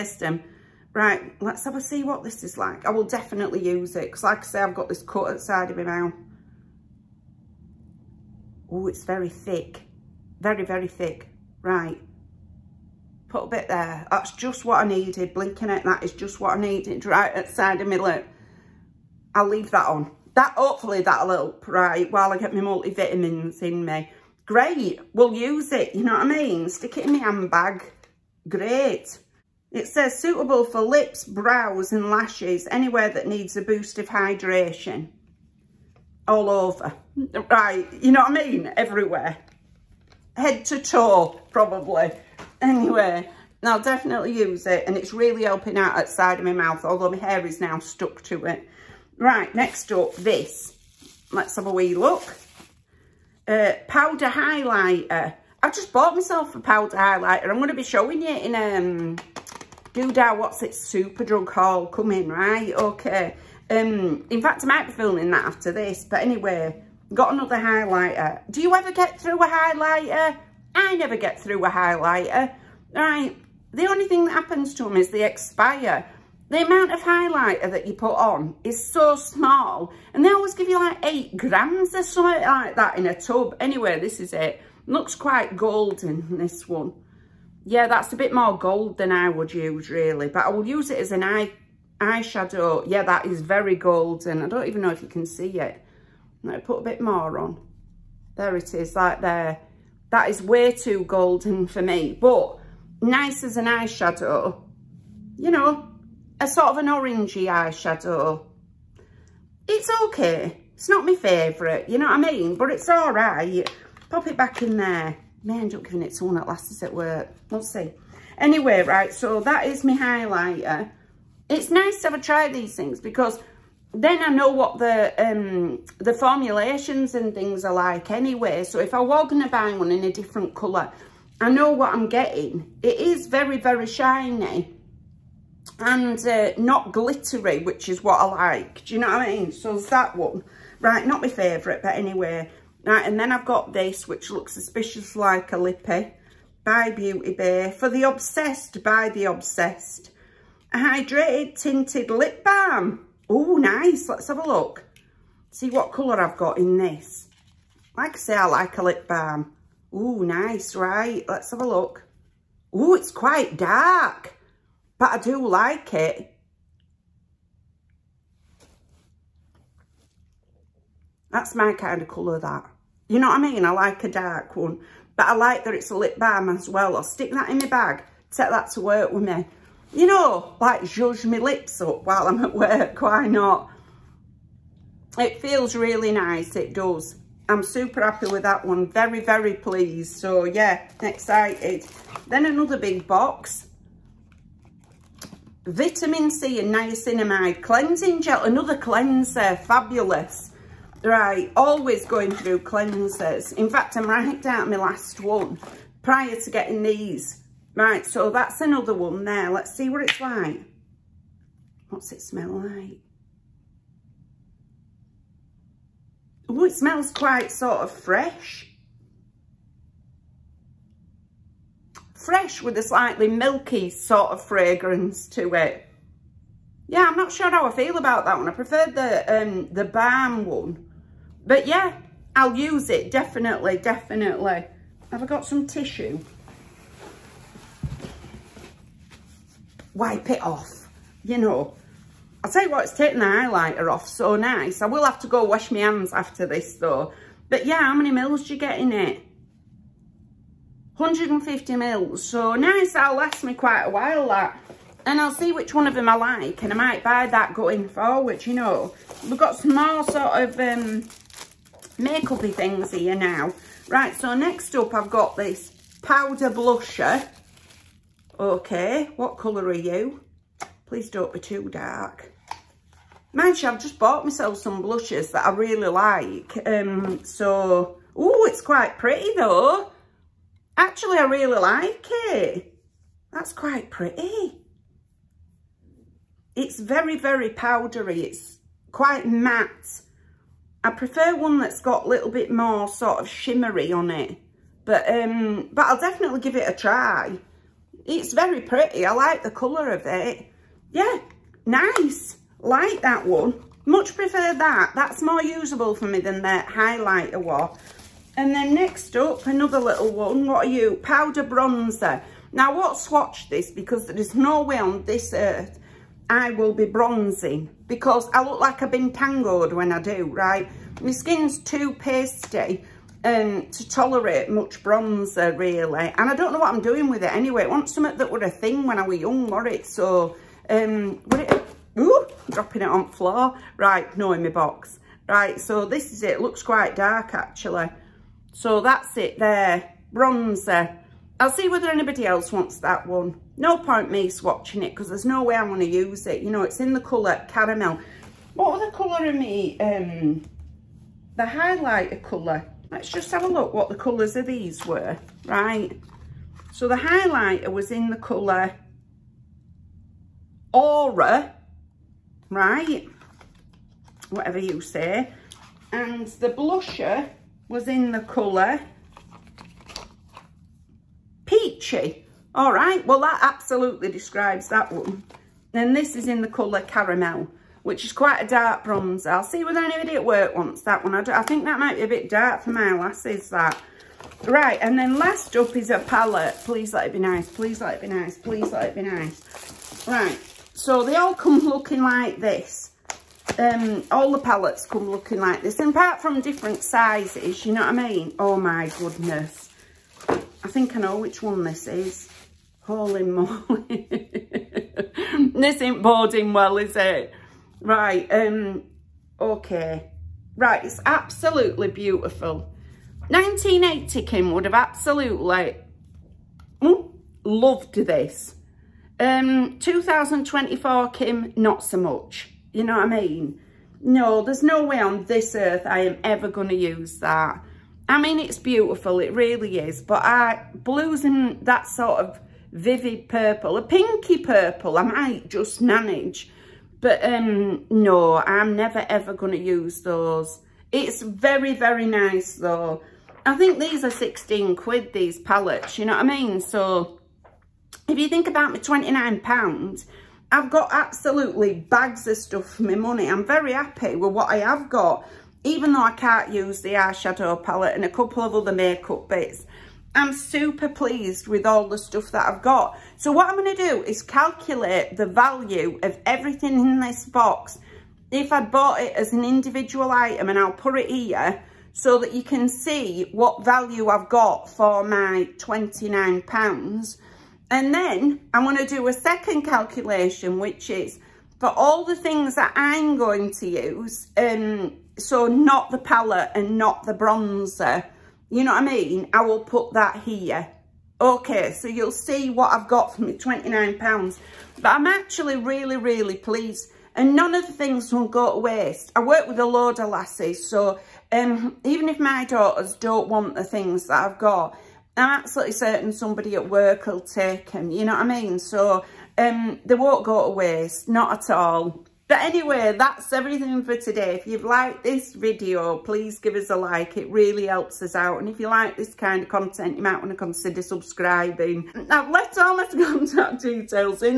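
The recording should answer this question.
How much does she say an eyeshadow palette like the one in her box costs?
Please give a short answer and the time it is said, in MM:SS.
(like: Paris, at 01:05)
£16, at 07:24.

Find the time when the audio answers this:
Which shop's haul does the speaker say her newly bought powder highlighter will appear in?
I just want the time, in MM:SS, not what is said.
01:00.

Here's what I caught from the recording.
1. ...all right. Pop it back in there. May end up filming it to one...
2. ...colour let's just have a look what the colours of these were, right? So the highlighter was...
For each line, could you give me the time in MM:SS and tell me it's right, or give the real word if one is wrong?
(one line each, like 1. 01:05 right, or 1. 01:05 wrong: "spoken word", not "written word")
1. 01:52 wrong: "giving", not "filming"
2. 05:52 right.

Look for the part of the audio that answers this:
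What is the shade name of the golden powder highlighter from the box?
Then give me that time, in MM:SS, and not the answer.
06:00.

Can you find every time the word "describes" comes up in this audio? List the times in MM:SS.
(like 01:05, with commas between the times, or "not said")
06:14.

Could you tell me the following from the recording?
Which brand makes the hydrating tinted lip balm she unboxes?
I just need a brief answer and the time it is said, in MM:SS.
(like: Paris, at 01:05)
Beauty Bay, at 02:26.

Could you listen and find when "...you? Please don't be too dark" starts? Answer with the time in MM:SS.
04:29.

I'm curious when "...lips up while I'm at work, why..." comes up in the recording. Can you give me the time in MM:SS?
03:01.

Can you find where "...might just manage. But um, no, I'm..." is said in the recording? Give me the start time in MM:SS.
07:15.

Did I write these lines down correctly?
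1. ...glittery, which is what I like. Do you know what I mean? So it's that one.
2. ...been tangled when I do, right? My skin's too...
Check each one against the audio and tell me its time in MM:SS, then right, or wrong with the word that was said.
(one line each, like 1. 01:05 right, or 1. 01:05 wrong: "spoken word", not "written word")
1. 02:16 right
2. 05:18 right.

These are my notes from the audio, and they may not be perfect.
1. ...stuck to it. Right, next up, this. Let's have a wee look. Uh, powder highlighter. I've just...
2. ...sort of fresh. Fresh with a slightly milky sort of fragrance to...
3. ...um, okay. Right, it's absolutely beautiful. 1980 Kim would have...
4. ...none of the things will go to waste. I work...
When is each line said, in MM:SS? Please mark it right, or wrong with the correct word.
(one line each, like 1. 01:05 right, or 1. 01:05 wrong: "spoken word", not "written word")
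1. 00:47 right
2. 03:37 right
3. 06:48 right
4. 08:17 right.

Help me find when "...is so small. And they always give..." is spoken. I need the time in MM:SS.
01:18.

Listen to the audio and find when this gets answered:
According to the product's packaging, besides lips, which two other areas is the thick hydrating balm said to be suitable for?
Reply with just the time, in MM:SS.
00:31.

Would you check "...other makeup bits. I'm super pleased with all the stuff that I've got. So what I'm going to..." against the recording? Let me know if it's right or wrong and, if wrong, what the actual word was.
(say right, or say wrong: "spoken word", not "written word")
right.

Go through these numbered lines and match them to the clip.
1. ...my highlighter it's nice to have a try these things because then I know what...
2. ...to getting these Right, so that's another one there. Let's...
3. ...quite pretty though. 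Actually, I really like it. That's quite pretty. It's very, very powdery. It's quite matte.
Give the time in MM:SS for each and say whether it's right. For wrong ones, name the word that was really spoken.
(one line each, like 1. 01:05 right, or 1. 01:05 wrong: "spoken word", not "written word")
1. 01:59 right
2. 03:26 right
3. 04:38 right.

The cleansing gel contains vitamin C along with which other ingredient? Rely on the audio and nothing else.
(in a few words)
niacinamide.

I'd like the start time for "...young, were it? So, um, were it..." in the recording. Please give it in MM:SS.
05:29.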